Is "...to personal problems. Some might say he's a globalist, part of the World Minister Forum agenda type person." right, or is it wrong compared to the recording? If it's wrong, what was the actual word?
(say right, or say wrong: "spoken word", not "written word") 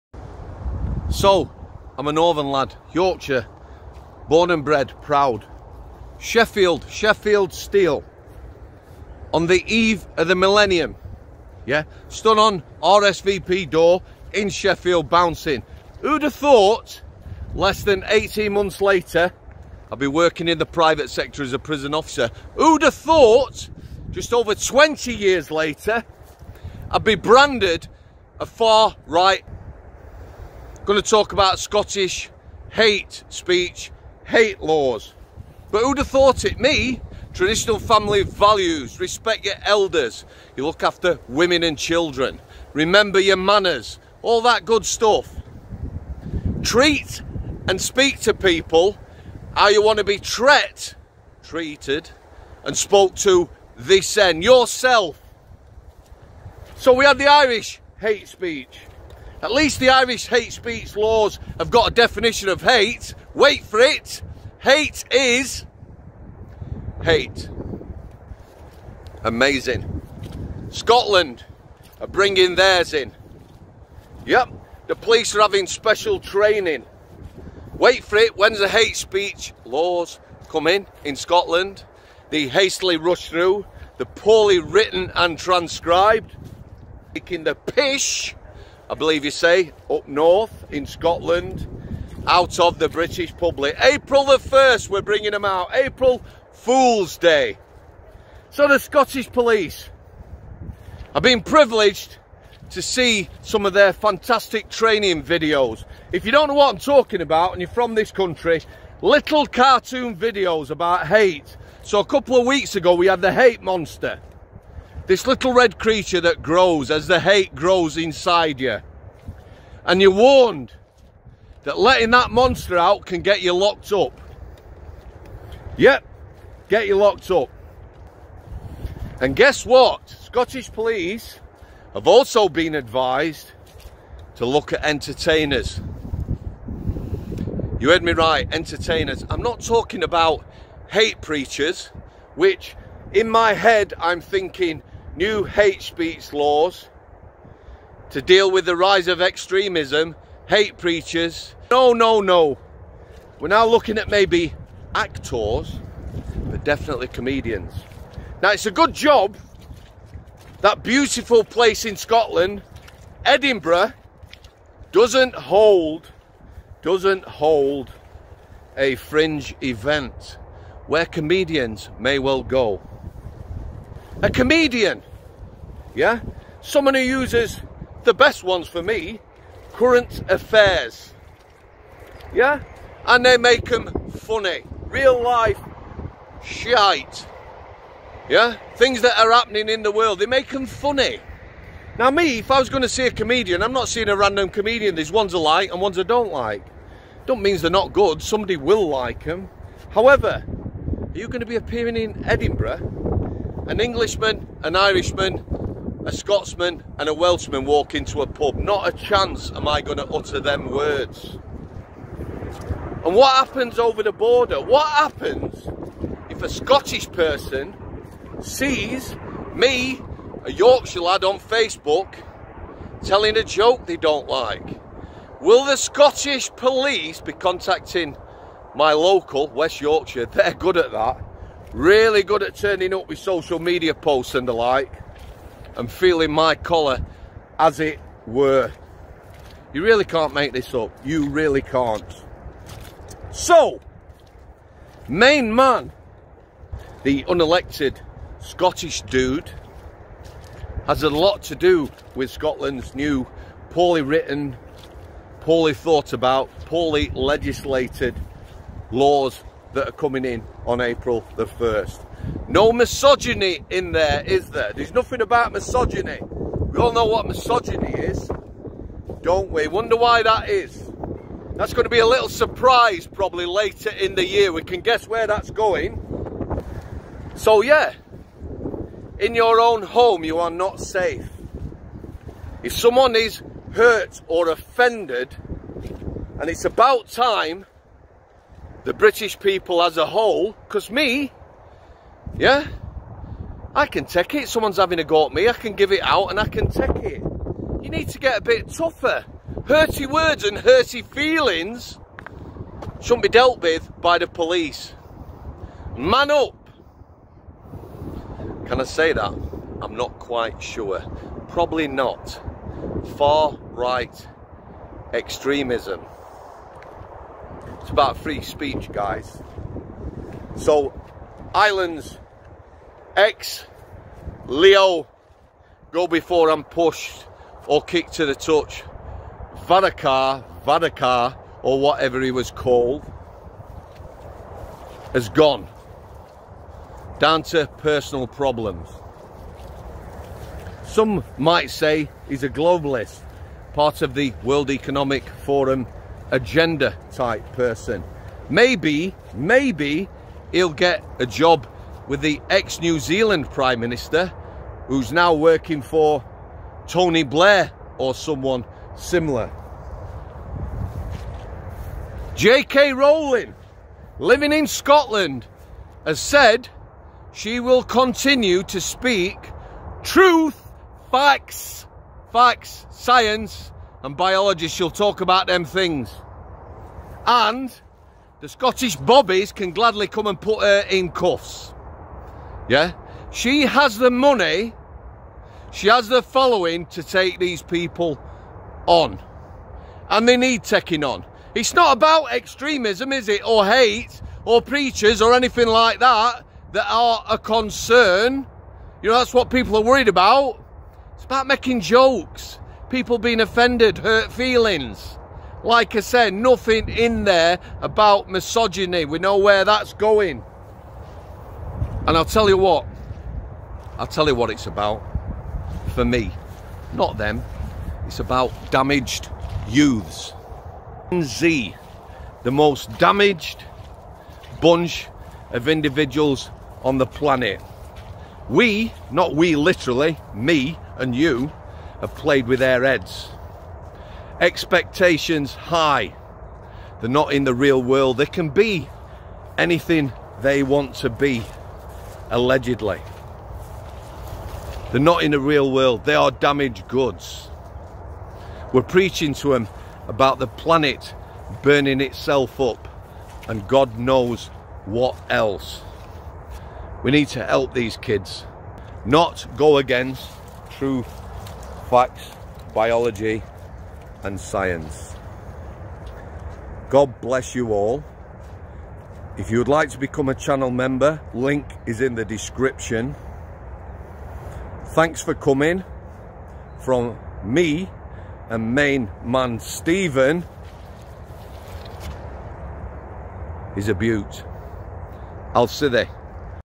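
wrong: "Economic", not "Minister".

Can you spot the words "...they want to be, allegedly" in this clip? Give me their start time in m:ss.
7:20.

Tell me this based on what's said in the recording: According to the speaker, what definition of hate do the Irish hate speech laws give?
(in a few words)
Hate is hate.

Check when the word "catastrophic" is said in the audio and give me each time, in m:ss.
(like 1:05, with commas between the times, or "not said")
not said.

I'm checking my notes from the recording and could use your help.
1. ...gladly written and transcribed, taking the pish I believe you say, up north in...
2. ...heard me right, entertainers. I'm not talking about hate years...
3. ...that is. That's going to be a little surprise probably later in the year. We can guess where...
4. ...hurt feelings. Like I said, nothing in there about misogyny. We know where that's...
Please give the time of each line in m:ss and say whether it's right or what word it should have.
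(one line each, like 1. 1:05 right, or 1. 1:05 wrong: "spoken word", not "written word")
1. 1:24 wrong: "poorly", not "gladly"
2. 2:17 wrong: "preachers", not "years"
3. 4:30 right
4. 6:43 right.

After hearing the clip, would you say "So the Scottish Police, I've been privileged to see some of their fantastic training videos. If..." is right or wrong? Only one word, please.
right.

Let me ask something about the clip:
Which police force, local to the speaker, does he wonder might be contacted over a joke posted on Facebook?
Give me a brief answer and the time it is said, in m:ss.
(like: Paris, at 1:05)
West Yorkshire, at 3:49.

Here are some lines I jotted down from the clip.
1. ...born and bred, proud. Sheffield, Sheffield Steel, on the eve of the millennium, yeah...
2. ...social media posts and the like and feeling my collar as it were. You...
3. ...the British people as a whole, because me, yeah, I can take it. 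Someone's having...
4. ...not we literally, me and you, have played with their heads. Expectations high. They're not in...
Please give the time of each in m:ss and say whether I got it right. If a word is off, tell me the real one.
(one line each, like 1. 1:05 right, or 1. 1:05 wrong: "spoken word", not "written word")
1. 0:04 right
2. 3:53 right
3. 4:48 right
4. 7:09 right.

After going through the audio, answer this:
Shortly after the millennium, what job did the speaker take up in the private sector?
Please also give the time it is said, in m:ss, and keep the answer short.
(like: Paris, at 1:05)
prison officer, at 0:21.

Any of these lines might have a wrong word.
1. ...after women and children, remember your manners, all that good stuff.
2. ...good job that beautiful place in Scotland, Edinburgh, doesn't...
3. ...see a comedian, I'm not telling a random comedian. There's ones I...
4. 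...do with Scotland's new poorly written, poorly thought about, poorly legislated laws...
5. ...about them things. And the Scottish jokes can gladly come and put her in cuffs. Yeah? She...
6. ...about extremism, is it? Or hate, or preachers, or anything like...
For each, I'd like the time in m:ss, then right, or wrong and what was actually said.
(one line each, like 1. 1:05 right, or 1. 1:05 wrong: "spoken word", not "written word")
1. 0:40 right
2. 2:38 right
3. 3:12 wrong: "seeing", not "telling"
4. 4:11 right
5. 6:15 wrong: "bobbies", not "jokes"
6. 6:31 right.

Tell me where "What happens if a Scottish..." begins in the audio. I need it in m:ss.
3:34.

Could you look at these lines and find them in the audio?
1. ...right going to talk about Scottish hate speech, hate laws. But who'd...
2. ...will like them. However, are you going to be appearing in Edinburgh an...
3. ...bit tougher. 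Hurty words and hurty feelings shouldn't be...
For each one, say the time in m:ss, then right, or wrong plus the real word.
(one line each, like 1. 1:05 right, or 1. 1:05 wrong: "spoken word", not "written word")
1. 0:29 right
2. 3:18 right
3. 4:58 right.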